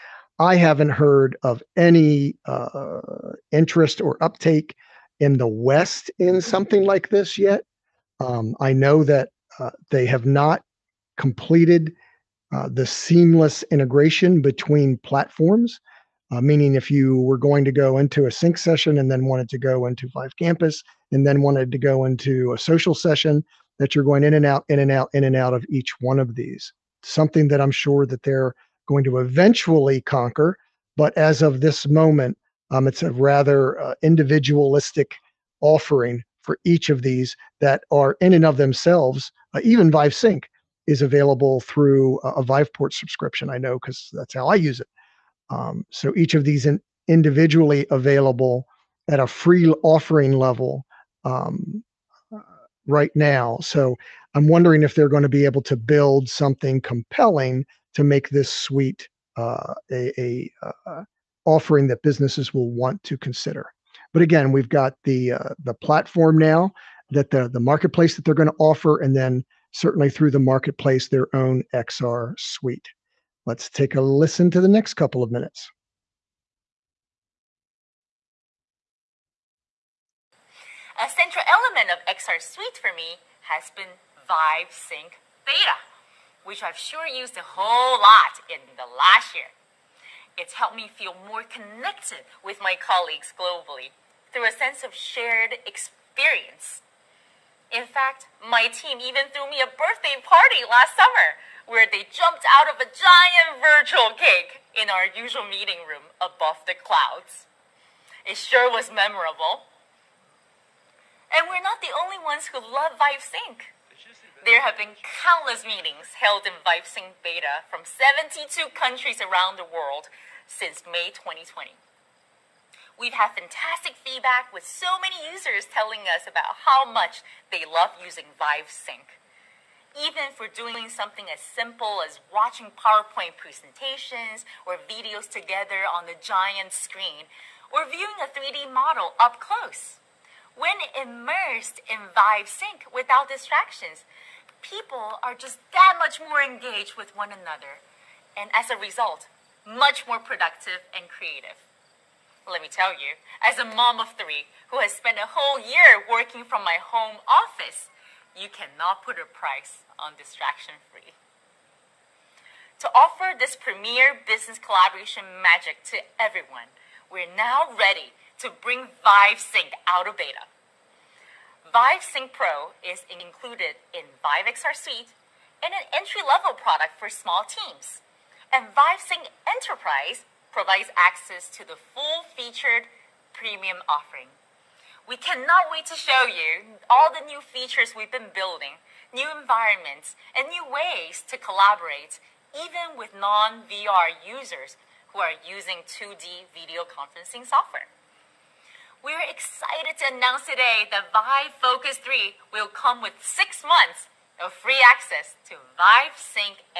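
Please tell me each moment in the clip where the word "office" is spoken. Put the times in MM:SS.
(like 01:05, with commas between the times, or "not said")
02:37.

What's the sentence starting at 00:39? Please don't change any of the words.
Uh, even Vive Sync is available through a, a Viveport subscription.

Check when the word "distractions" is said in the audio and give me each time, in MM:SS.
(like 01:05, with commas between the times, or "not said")
02:23, 02:40.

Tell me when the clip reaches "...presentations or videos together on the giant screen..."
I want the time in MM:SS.
02:13.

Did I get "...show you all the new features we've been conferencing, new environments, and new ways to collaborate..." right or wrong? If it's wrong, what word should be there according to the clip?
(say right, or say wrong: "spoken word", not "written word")
wrong: "building", not "conferencing".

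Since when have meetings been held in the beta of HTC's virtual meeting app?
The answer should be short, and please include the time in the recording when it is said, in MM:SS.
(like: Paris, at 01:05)
May 2020, at 02:00.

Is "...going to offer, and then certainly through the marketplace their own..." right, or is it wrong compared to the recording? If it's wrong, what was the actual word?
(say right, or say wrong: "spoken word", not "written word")
right.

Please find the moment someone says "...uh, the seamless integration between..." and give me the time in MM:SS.
00:12.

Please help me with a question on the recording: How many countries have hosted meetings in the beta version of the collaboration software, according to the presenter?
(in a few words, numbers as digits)
72.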